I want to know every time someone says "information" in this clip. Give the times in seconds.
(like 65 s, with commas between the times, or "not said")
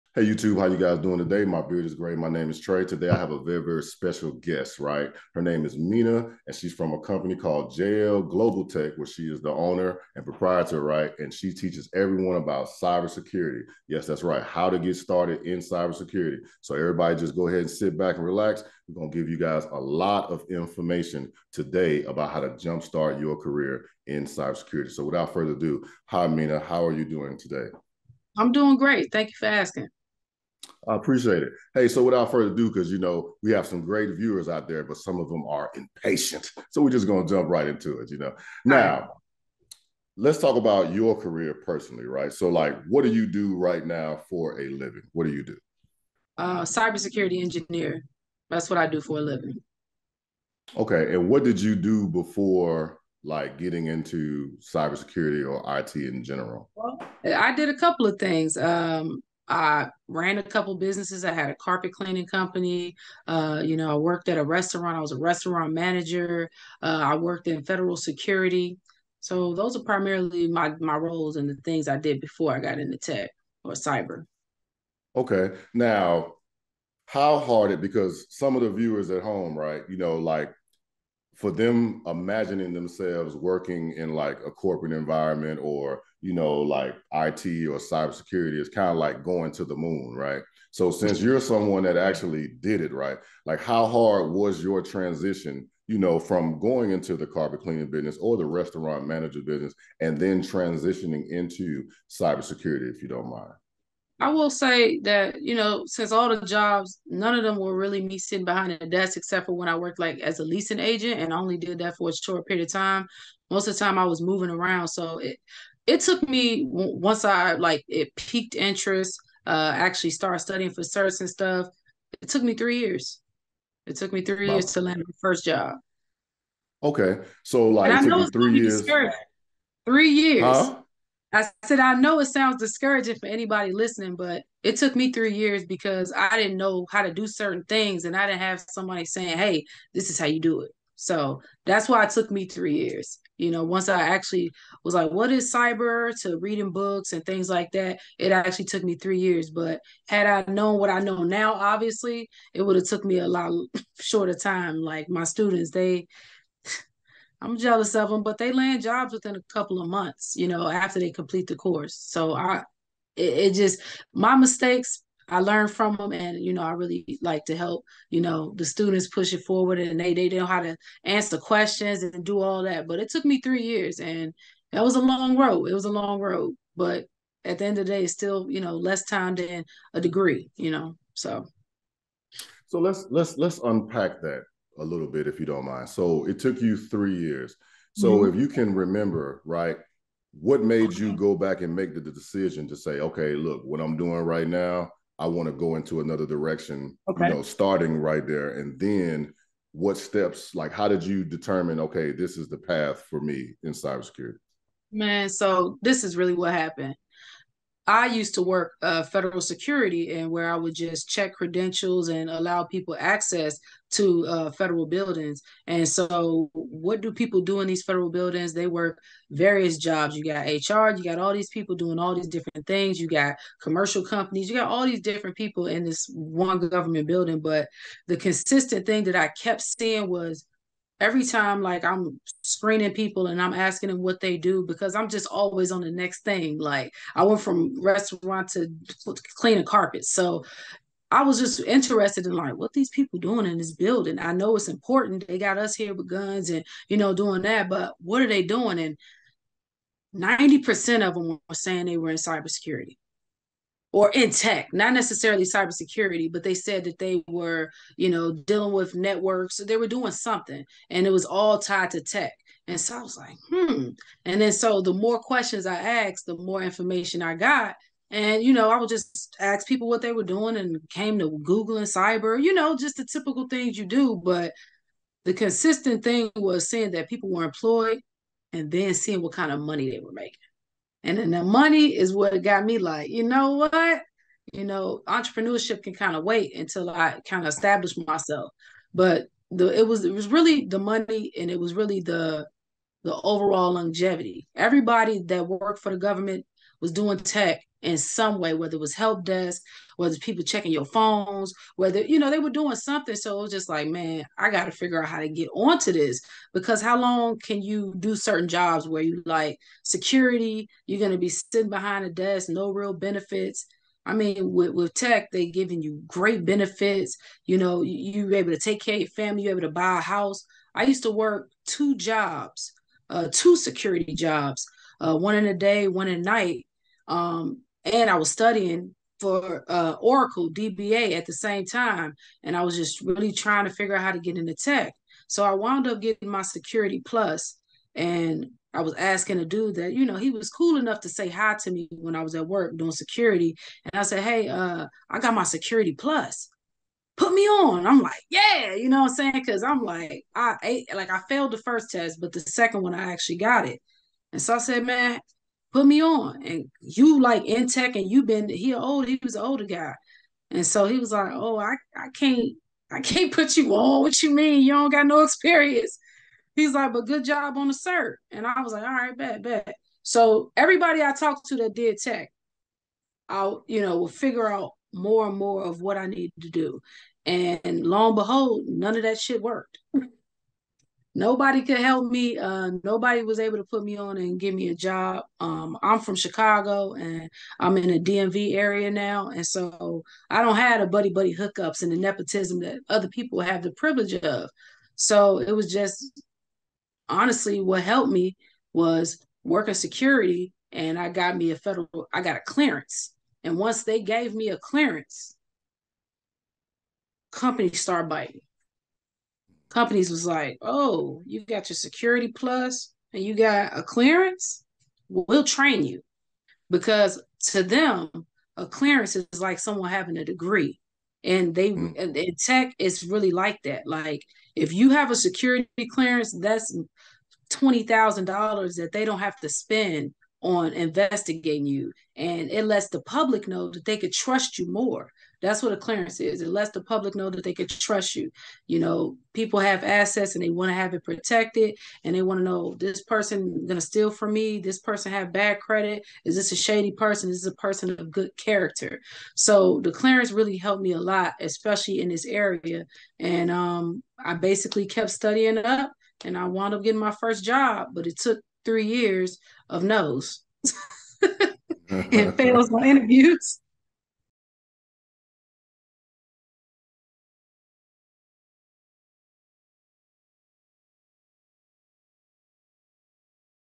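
20 s, 266 s.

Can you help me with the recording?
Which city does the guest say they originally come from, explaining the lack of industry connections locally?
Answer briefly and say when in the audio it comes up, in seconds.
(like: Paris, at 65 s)
Chicago, at 386 s.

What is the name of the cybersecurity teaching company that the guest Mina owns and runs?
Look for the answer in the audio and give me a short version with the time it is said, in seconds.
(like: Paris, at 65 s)
JL Global Tech, at 7 s.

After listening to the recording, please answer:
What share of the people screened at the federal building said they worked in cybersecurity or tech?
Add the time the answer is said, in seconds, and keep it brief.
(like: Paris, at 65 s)
90%, at 250 s.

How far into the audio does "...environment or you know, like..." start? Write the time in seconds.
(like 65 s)
84 s.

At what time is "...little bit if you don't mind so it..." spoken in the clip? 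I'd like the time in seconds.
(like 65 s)
184 s.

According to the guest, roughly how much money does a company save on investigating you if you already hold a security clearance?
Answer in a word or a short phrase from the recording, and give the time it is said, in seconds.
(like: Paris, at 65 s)
$20,000, at 427 s.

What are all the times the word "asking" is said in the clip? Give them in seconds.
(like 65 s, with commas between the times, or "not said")
29 s, 233 s, 338 s.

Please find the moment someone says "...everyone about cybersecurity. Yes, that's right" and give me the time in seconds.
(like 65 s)
11 s.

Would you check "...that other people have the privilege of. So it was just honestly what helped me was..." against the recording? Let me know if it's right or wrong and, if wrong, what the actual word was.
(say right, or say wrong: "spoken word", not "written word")
right.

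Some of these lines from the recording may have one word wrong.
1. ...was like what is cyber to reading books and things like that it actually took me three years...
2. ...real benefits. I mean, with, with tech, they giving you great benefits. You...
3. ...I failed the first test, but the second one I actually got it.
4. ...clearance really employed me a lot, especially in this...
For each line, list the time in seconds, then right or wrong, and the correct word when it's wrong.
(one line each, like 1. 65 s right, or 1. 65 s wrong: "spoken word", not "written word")
1. 144 s right
2. 312 s right
3. 351 s right
4. 449 s wrong: "helped", not "employed".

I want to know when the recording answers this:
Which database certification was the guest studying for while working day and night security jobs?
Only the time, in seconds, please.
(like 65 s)
329 s.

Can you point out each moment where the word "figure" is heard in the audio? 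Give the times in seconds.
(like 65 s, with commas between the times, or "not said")
304 s, 333 s, 374 s.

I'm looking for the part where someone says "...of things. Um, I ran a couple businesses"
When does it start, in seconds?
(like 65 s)
58 s.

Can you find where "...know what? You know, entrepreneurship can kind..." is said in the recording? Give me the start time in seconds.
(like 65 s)
283 s.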